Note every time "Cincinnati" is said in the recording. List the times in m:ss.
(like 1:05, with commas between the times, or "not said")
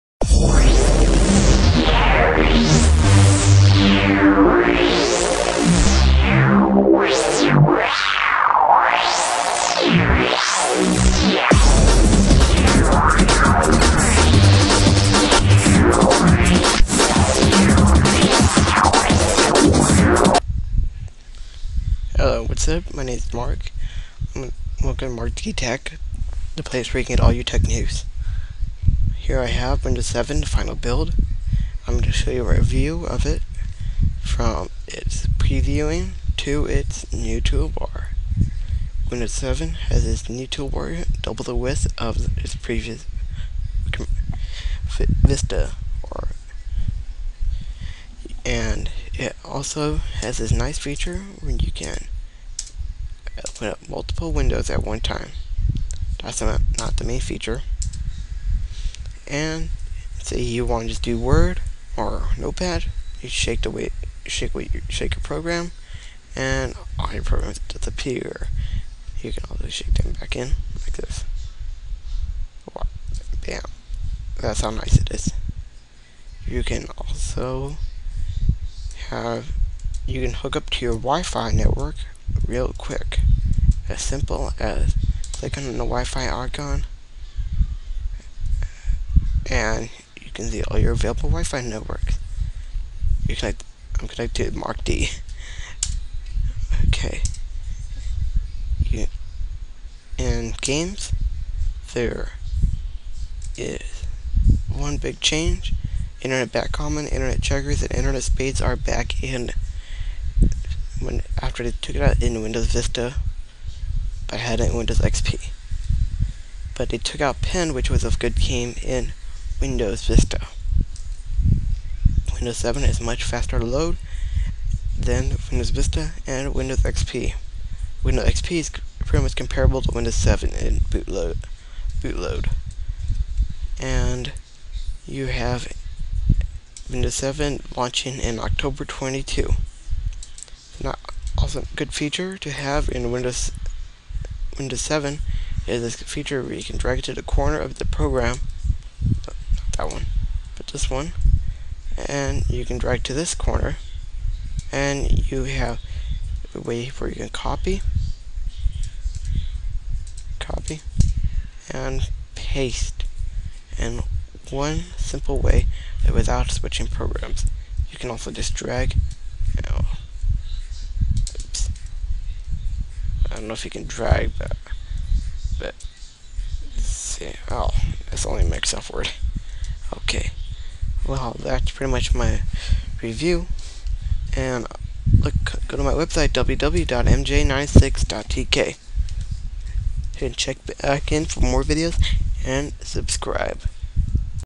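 not said.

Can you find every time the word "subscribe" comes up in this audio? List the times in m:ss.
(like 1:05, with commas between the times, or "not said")
3:12.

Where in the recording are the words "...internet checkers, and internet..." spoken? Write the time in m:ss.
1:47.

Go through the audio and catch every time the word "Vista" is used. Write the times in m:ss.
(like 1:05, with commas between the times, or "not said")
0:44, 1:52, 2:00, 2:05.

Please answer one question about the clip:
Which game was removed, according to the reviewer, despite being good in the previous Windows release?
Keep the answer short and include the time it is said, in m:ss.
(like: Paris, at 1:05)
Pen, at 1:57.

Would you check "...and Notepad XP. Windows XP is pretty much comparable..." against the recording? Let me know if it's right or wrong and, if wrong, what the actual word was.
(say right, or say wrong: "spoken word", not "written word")
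wrong: "Windows", not "Notepad".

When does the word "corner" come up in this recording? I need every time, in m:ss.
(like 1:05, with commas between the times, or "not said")
2:27, 2:33.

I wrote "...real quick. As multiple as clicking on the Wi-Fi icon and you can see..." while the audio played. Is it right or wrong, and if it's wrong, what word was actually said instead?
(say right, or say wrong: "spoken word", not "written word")
wrong: "simple", not "multiple".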